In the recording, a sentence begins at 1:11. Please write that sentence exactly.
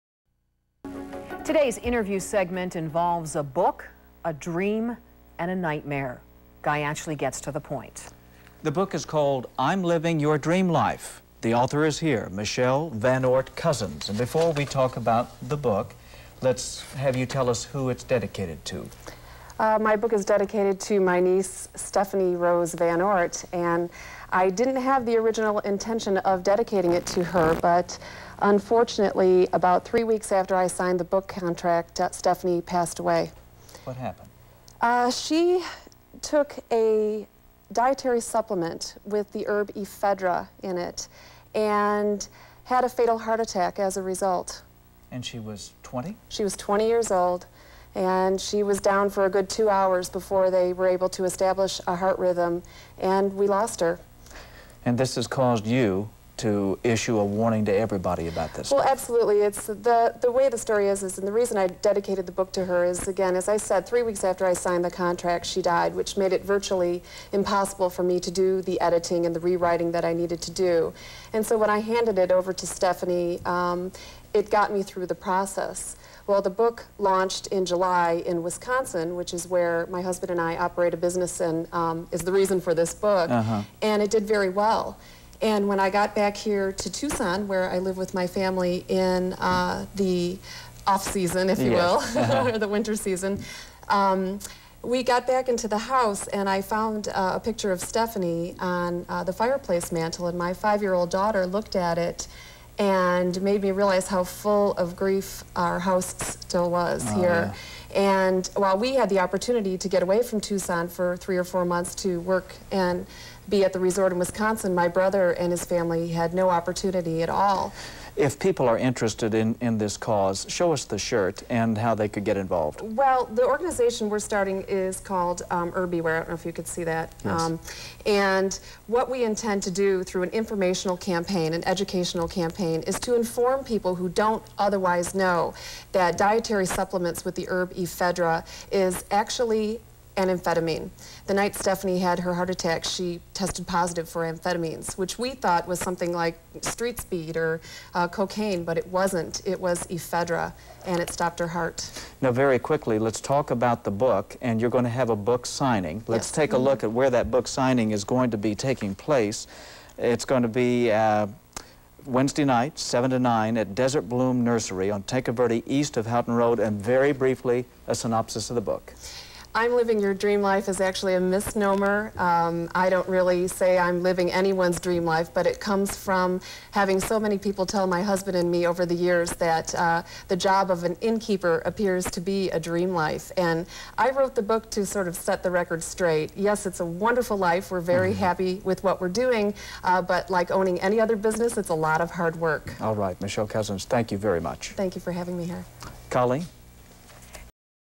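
And so when I handed it over to Stephanie, um, it got me through the process.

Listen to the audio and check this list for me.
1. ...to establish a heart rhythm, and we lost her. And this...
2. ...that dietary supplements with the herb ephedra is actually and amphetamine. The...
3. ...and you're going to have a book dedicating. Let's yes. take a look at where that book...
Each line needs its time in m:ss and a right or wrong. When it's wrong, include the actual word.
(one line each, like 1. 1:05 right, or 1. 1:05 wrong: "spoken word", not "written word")
1. 0:51 right
2. 2:15 right
3. 2:34 wrong: "signing", not "dedicating".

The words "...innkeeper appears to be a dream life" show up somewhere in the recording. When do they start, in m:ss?
3:01.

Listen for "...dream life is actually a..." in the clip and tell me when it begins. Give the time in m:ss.
2:50.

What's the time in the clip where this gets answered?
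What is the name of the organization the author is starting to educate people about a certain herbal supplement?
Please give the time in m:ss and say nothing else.
2:05.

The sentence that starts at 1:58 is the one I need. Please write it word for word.
If people are interested in, in this cause, show us the shirt and how they could get involved.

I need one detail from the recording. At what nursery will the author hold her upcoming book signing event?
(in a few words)
Desert Bloom Nursery.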